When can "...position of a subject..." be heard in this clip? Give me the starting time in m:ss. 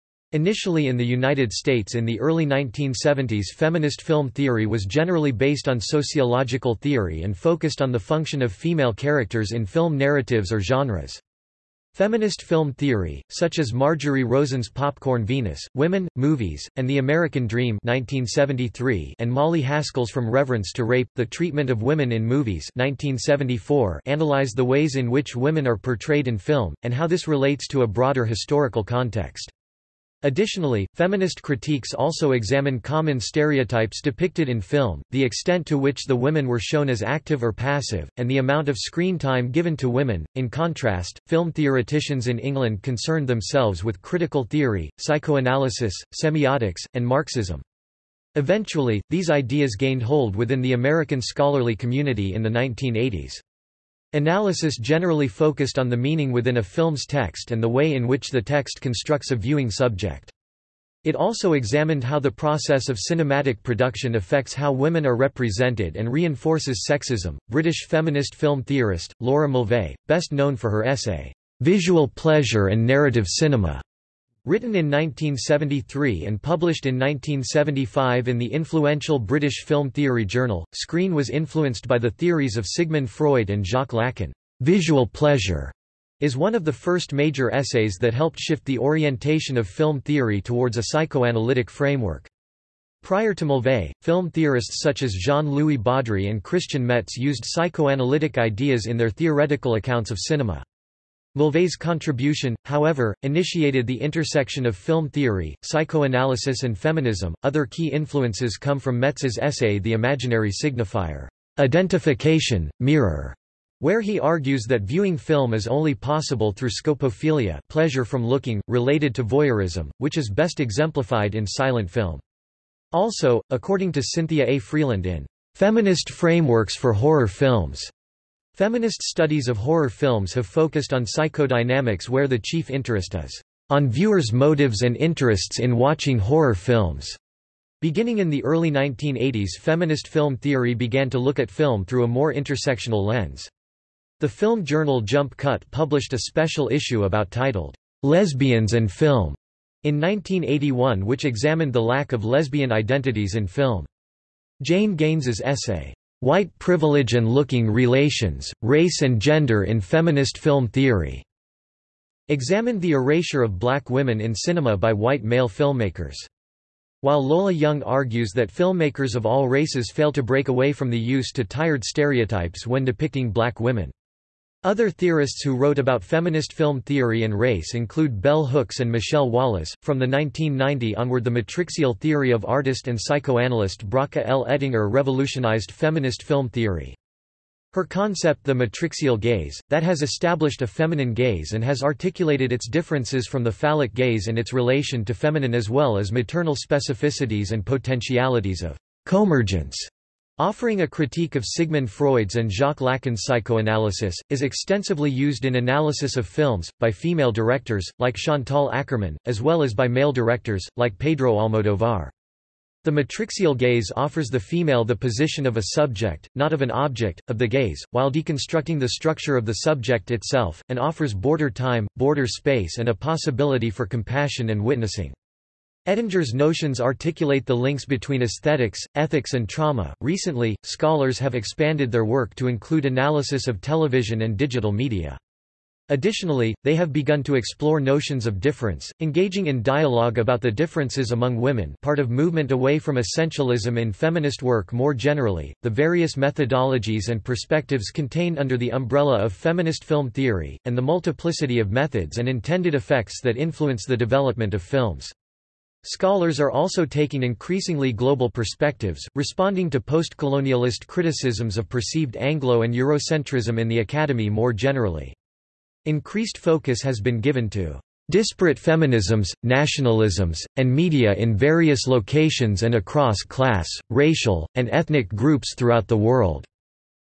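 3:34.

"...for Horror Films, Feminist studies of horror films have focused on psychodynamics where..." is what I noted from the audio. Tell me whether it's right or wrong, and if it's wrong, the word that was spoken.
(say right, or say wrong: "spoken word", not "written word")
right.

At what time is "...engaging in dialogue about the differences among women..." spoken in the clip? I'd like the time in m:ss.
3:58.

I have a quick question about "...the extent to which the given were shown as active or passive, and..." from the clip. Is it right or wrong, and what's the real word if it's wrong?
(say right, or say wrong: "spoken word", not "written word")
wrong: "women", not "given".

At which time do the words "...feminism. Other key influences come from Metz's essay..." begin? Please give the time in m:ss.
1:46.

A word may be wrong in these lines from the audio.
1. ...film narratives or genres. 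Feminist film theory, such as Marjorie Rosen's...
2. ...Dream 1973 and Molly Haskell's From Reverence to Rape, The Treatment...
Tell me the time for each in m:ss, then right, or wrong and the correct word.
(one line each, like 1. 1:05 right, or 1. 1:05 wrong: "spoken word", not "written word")
1. 0:09 right
2. 0:17 right.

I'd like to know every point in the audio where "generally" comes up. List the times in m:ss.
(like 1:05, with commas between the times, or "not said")
0:04, 0:54, 4:04, 4:24.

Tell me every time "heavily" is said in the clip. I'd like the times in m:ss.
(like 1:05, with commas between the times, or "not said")
not said.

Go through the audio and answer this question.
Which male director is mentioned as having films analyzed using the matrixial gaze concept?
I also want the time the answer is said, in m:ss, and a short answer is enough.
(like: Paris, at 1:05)
Pedro Almodovar, at 3:30.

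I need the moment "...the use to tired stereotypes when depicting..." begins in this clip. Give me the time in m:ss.
2:50.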